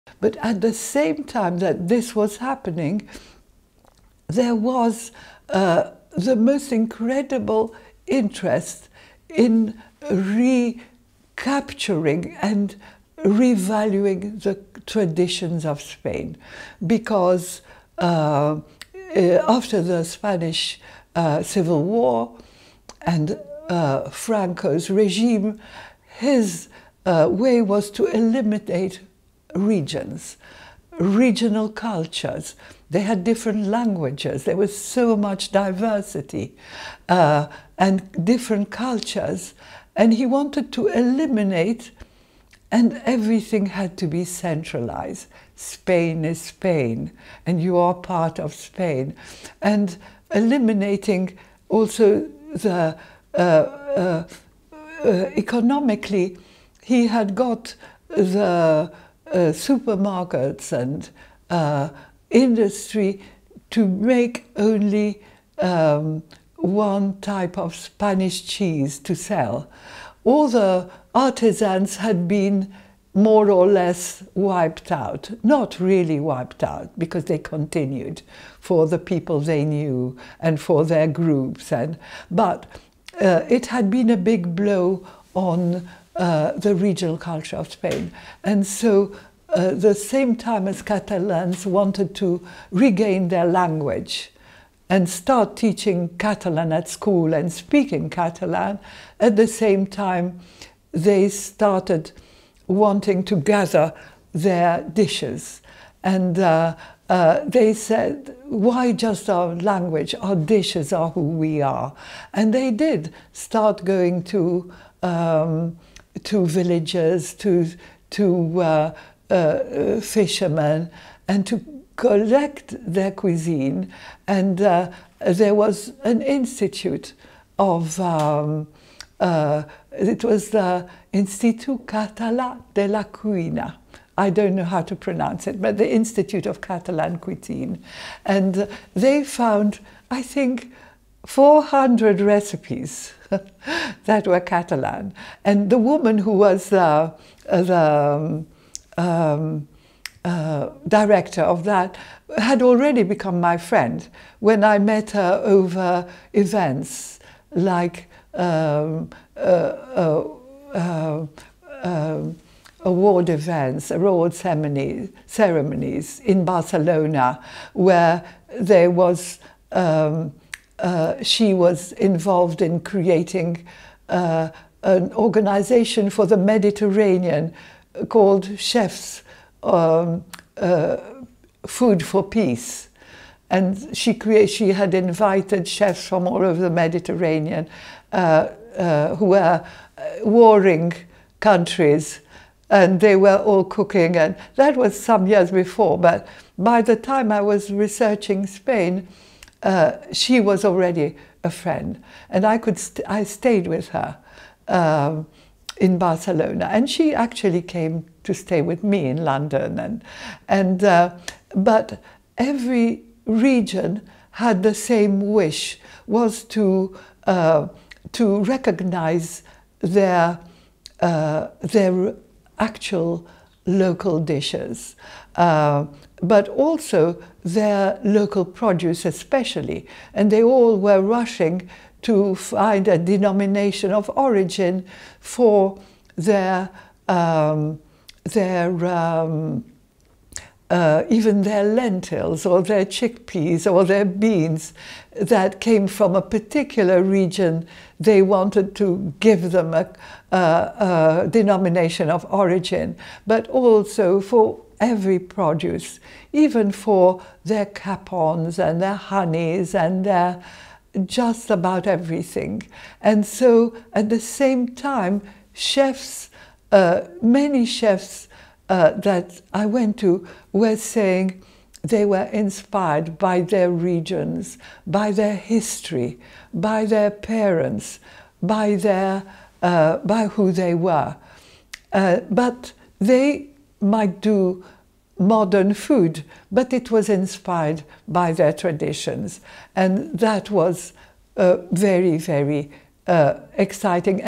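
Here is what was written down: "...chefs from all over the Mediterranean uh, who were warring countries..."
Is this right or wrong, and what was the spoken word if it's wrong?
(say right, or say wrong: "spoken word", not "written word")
right.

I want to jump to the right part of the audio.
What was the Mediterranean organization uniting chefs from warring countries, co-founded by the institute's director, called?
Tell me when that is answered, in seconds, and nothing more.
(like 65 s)
181 s.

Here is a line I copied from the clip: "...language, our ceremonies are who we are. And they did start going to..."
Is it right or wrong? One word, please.
wrong.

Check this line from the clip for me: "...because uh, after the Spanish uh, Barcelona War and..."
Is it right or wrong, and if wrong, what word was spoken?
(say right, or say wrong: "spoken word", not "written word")
wrong: "Civil", not "Barcelona".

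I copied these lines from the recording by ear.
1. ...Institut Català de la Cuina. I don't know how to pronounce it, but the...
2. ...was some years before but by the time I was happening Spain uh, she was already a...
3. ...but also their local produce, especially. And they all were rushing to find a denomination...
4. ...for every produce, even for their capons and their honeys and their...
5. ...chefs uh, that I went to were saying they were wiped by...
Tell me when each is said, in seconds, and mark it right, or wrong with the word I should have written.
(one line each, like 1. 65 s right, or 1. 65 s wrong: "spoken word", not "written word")
1. 131 s right
2. 194 s wrong: "researching", not "happening"
3. 226 s right
4. 254 s right
5. 267 s wrong: "inspired", not "wiped".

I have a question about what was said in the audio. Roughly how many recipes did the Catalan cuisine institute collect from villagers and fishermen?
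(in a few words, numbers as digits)
400.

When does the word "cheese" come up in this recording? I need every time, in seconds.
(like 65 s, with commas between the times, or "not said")
68 s.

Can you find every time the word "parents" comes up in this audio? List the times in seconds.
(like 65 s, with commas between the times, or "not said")
277 s.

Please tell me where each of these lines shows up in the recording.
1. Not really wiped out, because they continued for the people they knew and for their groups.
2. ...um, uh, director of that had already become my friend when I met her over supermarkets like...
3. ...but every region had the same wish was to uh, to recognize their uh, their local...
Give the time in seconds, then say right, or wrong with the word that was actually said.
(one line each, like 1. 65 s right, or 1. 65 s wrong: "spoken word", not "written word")
1. 75 s right
2. 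149 s wrong: "events", not "supermarkets"
3. 211 s wrong: "actual", not "local".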